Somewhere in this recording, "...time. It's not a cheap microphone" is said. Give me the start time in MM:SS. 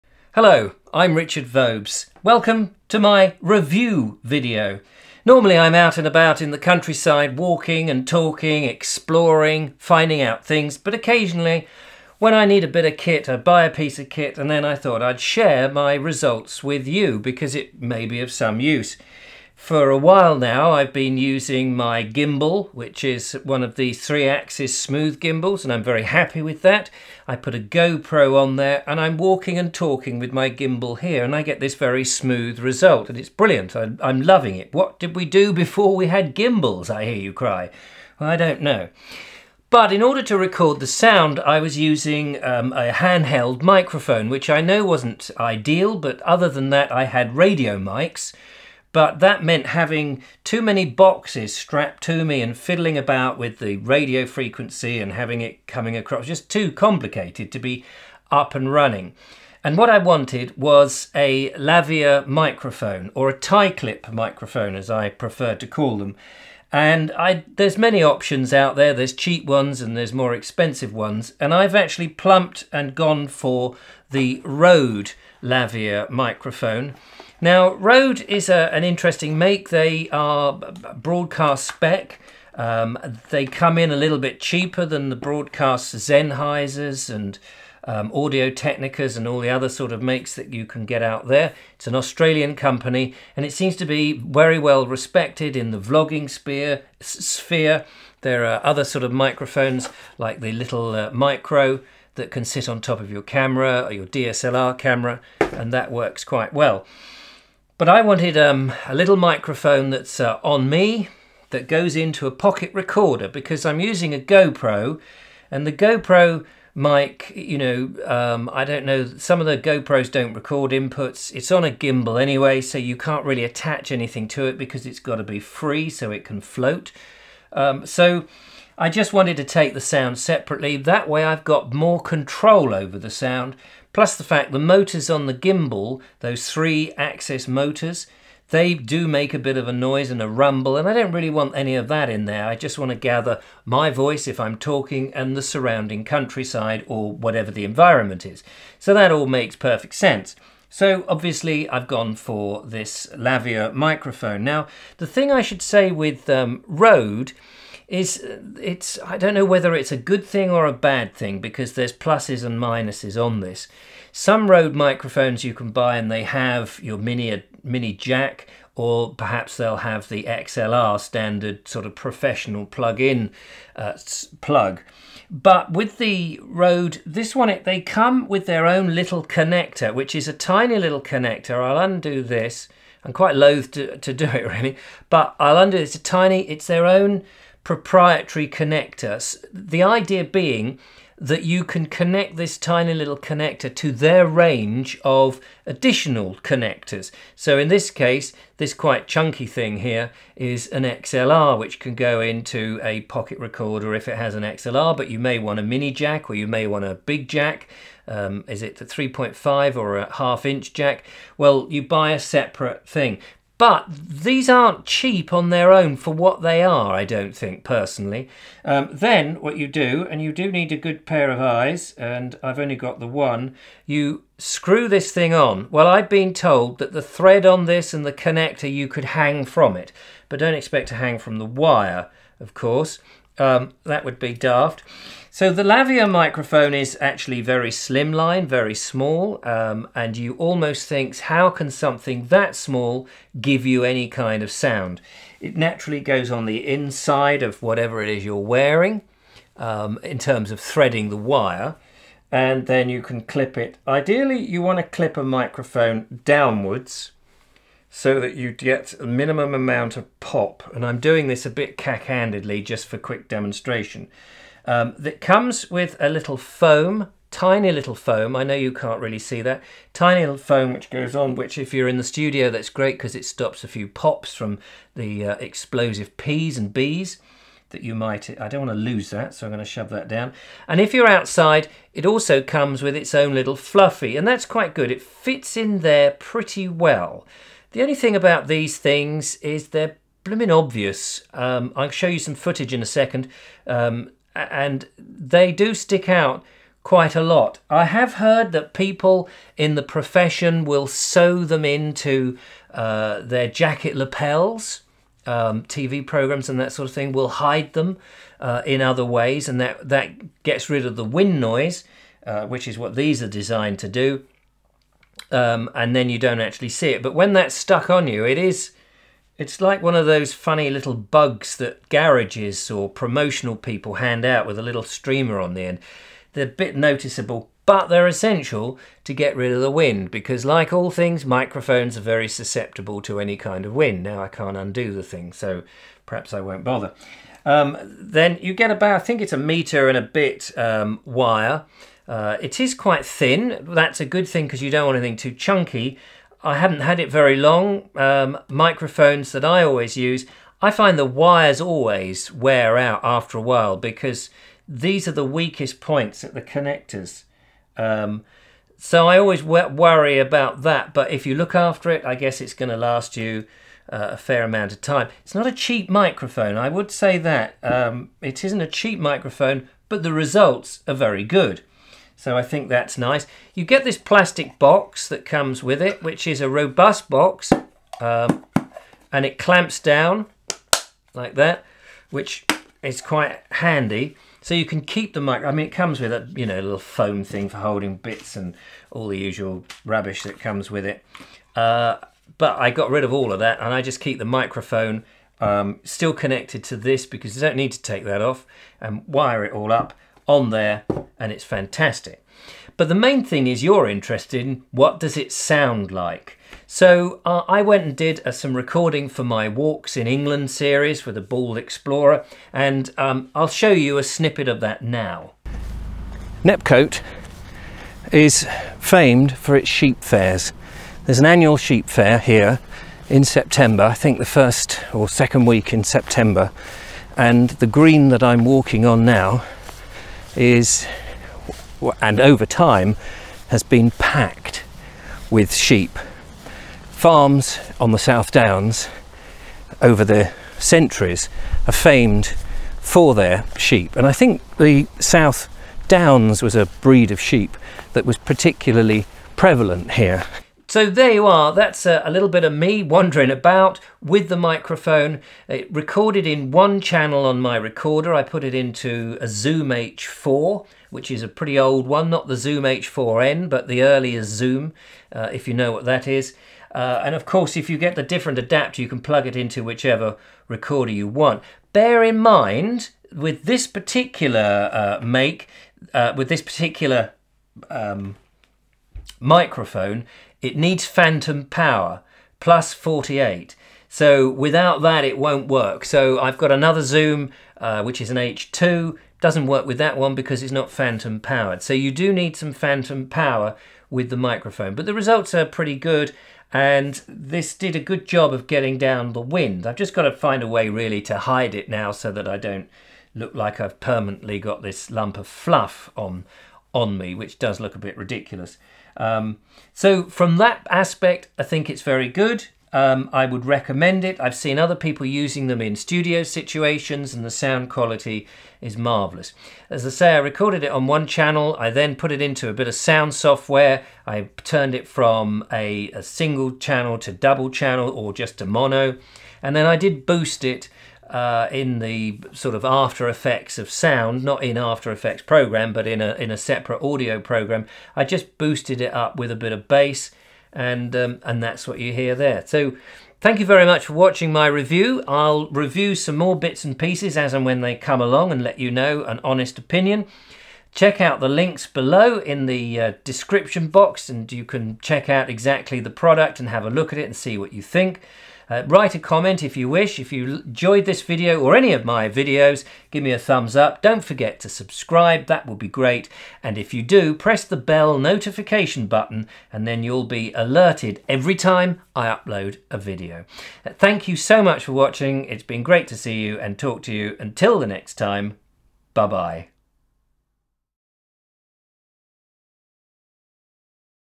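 06:04.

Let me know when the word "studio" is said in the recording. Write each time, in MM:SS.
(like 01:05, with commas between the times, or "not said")
04:32, 08:35.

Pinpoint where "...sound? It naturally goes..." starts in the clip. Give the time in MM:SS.
04:04.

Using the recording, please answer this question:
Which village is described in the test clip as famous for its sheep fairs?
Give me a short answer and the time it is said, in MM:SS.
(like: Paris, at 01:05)
Nepcote, at 06:56.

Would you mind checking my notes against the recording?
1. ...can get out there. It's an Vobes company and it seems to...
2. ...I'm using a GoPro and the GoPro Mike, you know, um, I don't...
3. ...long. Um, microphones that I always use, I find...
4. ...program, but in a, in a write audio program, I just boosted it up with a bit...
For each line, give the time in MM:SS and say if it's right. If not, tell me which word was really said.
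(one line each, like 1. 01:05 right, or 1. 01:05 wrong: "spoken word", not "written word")
1. 01:30 wrong: "Australian", not "Vobes"
2. 01:53 right
3. 05:47 right
4. 08:55 wrong: "separate", not "write".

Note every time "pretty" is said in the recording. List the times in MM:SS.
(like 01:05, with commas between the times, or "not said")
04:46, 07:41, 08:15.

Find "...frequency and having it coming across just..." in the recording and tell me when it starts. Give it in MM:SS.
00:54.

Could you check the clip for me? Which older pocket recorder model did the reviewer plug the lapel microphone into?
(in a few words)
Zoom H4.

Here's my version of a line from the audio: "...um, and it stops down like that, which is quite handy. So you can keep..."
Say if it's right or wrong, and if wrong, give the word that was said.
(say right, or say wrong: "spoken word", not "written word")
wrong: "clamps", not "stops".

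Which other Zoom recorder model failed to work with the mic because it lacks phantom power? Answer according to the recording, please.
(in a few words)
H2.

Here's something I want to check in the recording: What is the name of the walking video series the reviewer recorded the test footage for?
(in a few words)
Walks in England.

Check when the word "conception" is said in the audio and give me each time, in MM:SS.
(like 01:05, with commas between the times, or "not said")
not said.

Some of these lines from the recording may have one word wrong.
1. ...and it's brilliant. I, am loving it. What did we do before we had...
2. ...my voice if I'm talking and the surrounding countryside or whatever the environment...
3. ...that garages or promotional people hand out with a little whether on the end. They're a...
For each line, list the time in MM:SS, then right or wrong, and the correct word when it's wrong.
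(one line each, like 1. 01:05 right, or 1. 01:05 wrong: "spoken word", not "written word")
1. 00:33 right
2. 02:23 right
3. 05:21 wrong: "streamer", not "whether".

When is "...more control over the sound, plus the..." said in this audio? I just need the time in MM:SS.
02:11.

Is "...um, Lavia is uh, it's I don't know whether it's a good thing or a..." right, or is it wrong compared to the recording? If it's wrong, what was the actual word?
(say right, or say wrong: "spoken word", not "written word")
wrong: "Rode", not "Lavia".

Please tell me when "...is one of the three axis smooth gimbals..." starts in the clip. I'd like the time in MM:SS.
00:23.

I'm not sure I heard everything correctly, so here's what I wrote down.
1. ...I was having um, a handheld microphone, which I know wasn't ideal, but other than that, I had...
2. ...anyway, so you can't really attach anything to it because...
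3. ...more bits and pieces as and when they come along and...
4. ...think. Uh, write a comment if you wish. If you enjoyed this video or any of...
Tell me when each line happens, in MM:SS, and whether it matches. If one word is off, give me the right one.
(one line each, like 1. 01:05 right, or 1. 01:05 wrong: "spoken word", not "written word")
1. 00:41 wrong: "using", not "having"
2. 02:02 right
3. 09:06 right
4. 09:17 right.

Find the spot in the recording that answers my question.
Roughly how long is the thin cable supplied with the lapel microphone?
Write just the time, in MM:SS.
05:39.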